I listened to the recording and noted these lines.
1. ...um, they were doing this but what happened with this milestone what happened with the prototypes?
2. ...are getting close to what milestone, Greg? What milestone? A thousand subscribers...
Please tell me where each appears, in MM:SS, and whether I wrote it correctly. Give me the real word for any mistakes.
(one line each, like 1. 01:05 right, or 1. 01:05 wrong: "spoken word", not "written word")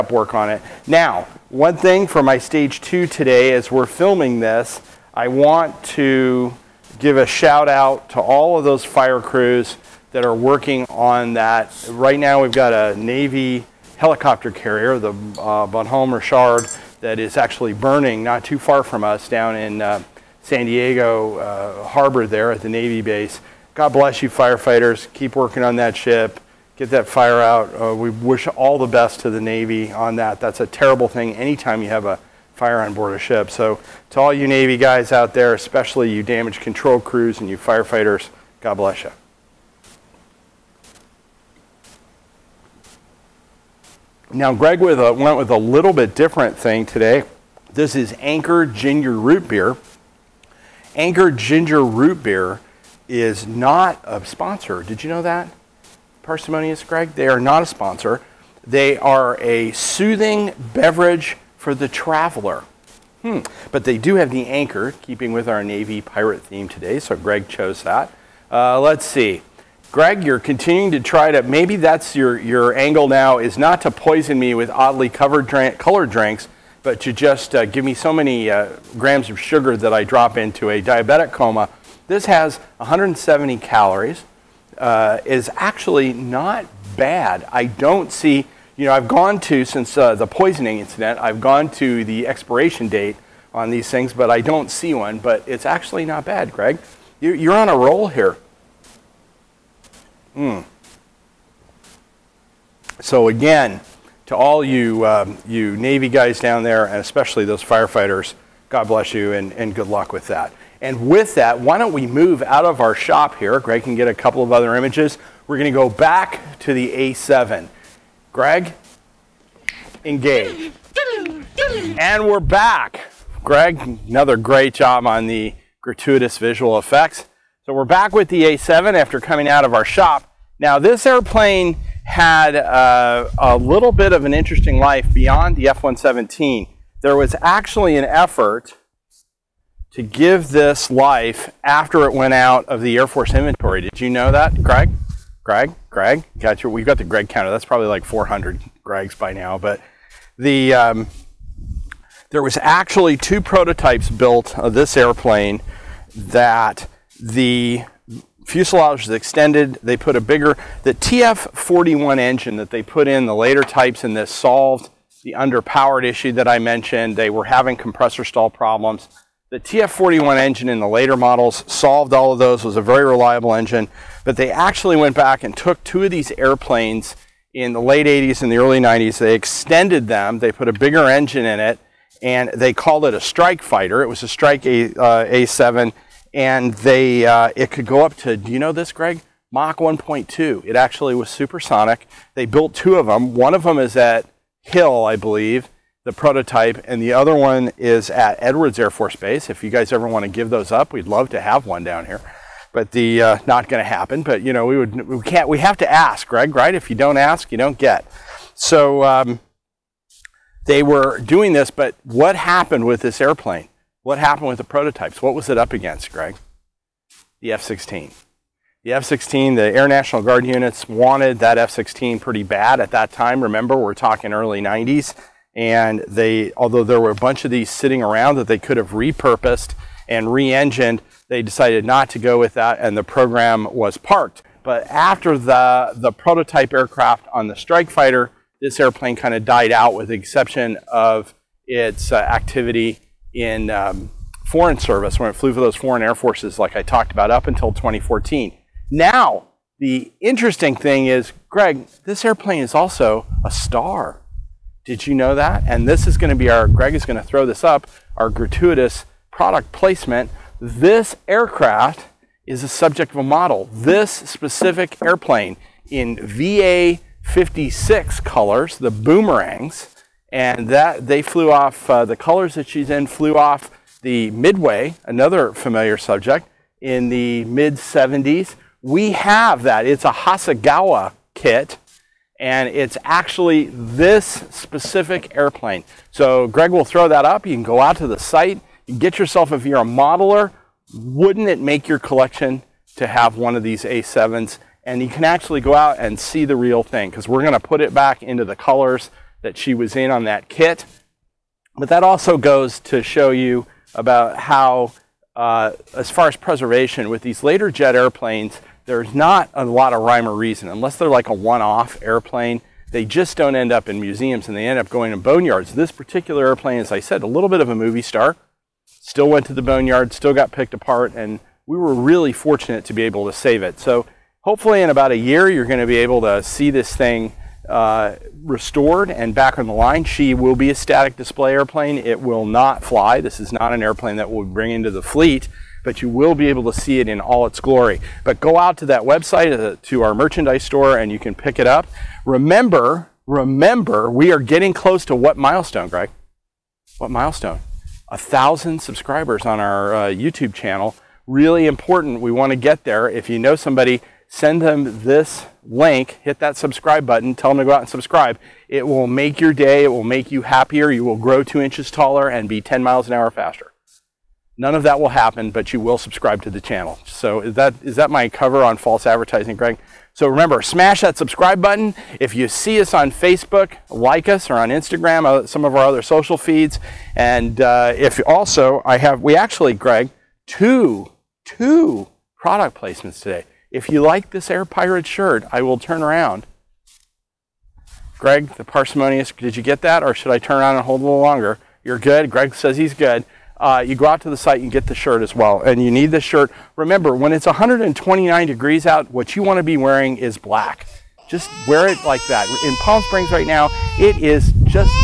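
1. 03:29 wrong: "airplane", not "milestone"
2. 05:44 right.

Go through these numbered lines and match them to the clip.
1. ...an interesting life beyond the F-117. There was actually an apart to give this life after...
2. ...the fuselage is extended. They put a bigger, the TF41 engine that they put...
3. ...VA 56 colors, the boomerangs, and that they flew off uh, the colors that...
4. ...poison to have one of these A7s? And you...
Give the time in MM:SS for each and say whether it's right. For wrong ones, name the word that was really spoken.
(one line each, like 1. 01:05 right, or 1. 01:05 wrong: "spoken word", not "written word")
1. 02:14 wrong: "effort", not "apart"
2. 02:37 right
3. 04:26 right
4. 04:52 wrong: "collection", not "poison".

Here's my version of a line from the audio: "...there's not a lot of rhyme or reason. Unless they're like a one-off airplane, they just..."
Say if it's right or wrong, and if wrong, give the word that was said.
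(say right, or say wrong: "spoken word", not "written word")
right.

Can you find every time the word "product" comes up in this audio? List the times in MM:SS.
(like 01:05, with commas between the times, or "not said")
04:19, 06:22.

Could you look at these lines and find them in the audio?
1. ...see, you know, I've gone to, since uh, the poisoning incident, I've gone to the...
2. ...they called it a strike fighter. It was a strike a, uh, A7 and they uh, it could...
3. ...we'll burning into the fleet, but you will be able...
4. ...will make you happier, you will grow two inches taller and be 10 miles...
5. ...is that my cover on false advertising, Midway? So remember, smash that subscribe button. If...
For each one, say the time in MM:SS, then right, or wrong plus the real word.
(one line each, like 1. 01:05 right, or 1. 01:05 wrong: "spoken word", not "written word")
1. 01:28 right
2. 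03:02 right
3. 05:34 wrong: "bring", not "burning"
4. 05:59 right
5. 06:07 wrong: "Greg", not "Midway".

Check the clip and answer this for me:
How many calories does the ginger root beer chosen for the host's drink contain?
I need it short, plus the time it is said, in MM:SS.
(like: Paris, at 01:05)
170, at 01:22.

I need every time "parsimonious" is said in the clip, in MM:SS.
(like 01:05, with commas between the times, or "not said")
00:56, 06:28.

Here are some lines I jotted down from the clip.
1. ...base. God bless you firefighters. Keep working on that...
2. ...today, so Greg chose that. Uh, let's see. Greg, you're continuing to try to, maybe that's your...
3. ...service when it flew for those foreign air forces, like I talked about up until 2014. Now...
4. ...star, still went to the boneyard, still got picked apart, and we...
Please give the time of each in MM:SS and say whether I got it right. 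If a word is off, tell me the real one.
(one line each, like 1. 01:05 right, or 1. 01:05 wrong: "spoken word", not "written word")
1. 00:23 right
2. 01:06 right
3. 04:04 right
4. 05:18 right.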